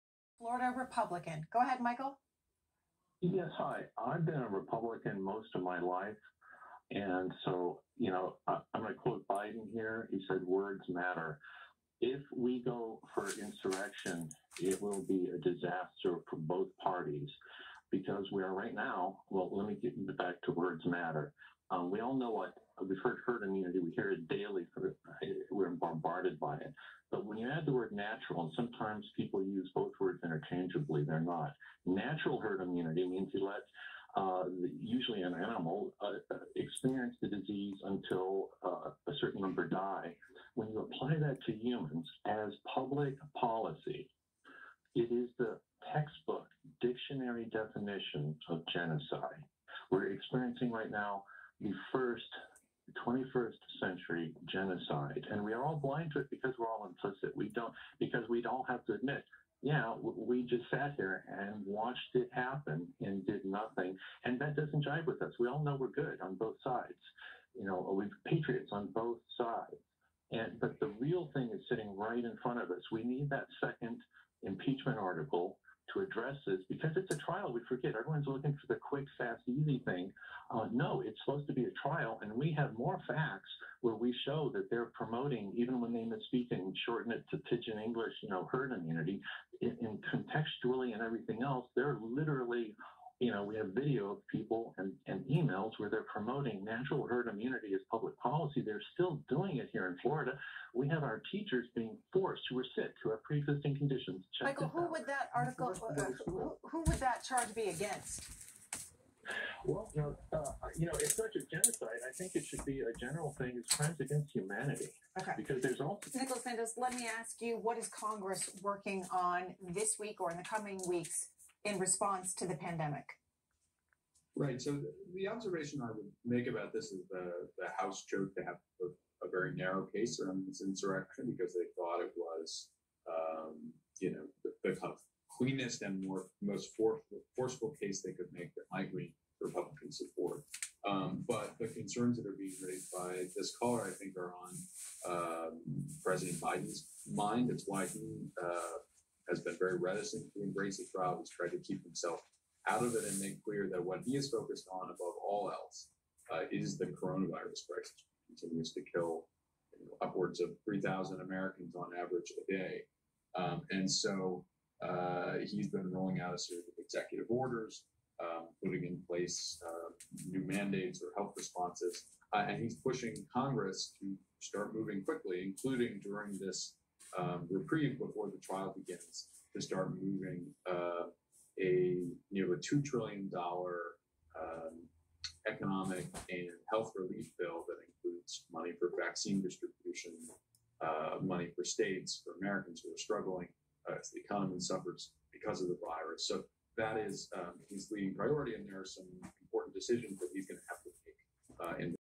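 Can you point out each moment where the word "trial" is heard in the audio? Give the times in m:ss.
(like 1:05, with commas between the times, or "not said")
1:17, 1:21, 2:30, 2:58.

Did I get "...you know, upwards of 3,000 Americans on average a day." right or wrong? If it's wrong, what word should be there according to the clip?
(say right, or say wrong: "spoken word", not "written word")
right.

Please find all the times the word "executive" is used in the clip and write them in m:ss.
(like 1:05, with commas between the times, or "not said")
2:46.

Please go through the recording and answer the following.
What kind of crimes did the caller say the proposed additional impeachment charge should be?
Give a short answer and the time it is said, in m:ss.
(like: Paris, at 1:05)
crimes against humanity, at 1:53.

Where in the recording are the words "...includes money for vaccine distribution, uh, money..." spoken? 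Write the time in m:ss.
3:07.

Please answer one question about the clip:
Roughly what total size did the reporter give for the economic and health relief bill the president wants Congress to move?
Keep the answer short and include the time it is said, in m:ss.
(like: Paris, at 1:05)
nearly $2 trillion, at 3:02.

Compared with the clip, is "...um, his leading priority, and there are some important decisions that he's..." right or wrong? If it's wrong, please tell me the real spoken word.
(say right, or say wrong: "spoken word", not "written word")
right.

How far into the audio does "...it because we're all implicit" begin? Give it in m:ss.
0:56.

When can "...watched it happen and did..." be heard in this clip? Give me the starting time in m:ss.
1:01.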